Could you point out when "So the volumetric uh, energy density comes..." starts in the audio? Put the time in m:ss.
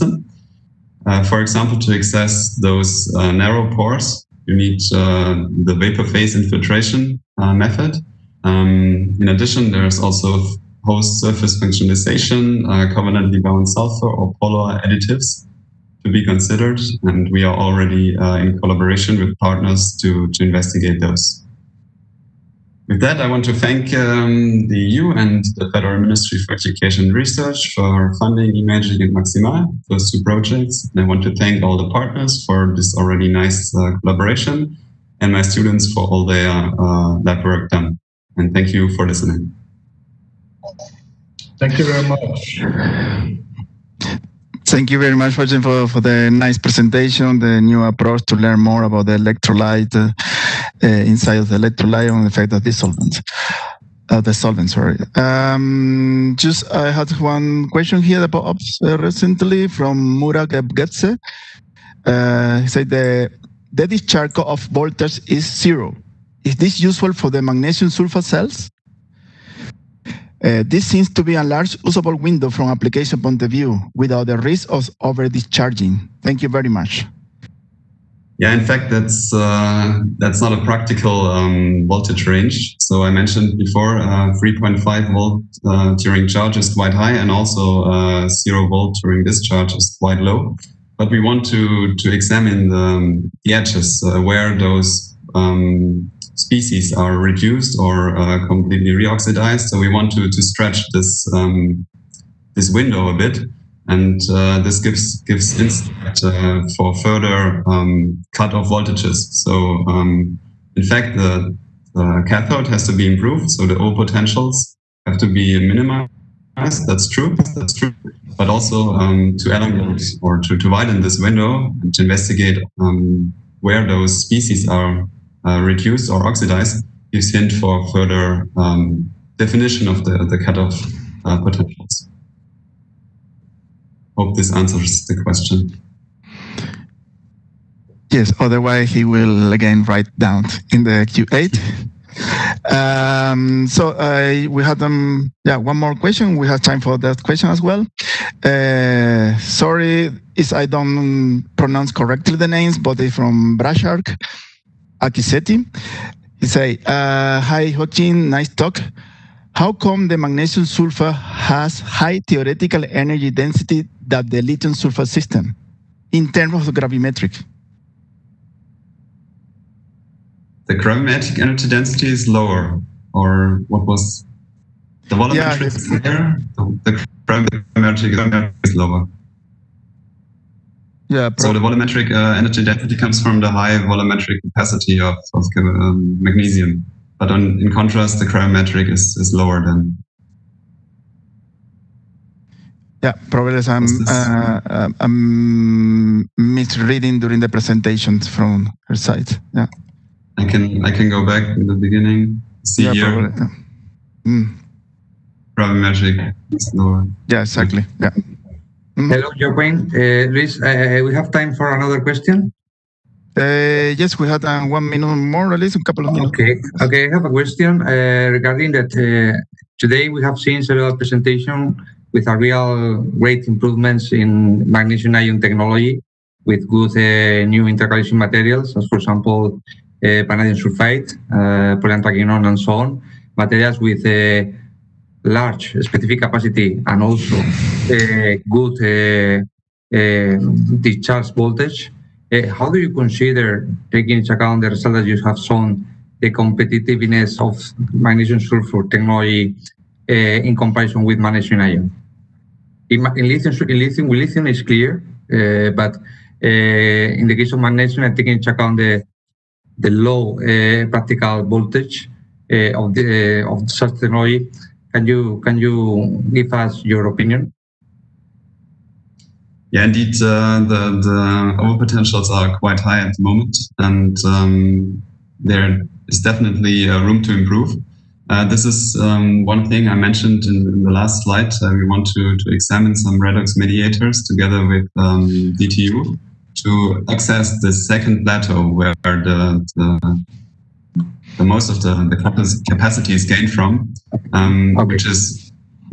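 3:01.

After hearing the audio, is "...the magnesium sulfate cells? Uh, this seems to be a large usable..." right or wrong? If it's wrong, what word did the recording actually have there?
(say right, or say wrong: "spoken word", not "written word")
right.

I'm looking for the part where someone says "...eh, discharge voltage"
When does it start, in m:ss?
3:59.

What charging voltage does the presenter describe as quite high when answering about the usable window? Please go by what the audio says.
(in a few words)
3.5 volts.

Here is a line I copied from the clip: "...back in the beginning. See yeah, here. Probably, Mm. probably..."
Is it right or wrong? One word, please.
right.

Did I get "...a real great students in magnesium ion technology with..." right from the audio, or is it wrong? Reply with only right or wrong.
wrong.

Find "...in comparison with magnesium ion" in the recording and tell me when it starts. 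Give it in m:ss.
4:10.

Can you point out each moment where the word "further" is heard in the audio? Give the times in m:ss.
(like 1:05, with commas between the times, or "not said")
1:46, 2:07.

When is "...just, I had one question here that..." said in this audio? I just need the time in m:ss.
0:56.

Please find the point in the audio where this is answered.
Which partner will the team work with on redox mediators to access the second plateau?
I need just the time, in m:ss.
4:45.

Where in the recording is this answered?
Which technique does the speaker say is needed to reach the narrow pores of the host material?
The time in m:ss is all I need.
0:05.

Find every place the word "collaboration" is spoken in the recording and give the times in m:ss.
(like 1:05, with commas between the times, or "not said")
0:18, 0:33.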